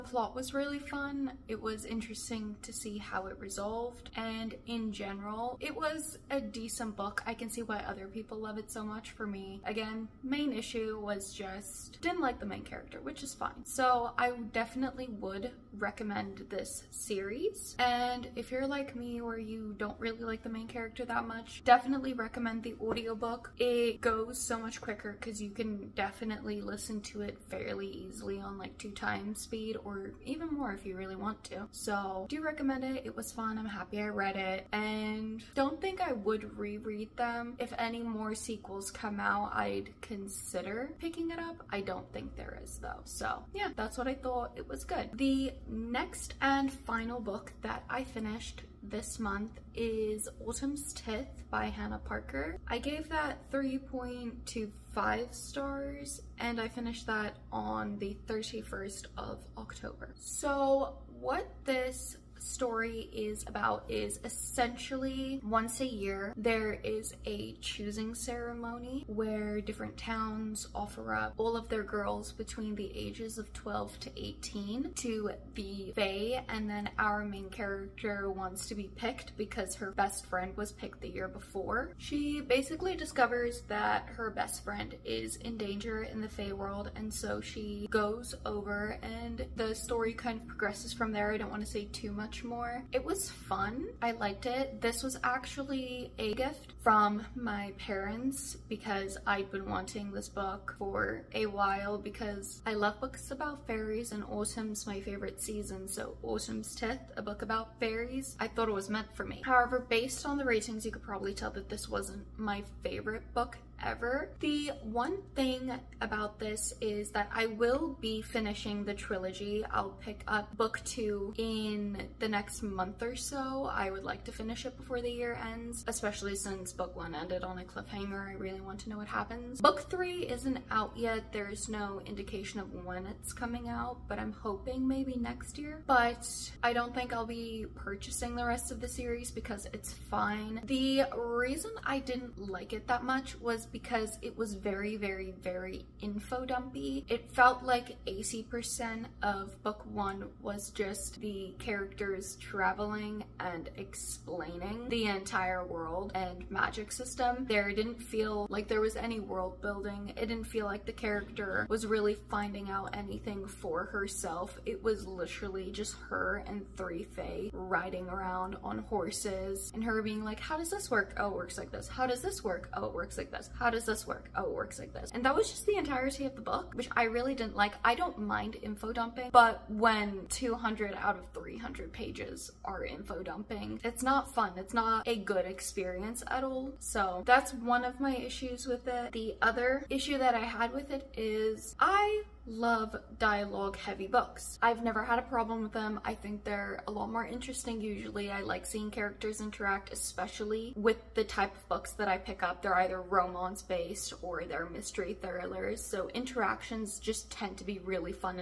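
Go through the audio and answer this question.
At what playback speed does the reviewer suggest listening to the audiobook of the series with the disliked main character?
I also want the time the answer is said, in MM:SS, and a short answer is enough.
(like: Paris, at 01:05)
2x, at 00:28.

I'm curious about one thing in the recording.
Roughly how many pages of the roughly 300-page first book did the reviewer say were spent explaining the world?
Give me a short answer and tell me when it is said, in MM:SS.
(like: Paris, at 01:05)
200, at 03:00.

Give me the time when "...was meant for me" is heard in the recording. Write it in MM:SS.
01:48.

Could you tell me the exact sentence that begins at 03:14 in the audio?
I've never had a problem with them.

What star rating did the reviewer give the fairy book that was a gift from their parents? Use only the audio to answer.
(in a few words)
3.25.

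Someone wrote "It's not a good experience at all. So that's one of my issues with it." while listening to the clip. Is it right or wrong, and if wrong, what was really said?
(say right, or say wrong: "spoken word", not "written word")
right.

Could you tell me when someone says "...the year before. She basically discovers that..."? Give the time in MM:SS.
01:21.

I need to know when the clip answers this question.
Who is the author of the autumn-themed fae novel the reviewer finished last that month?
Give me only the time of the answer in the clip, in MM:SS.
00:51.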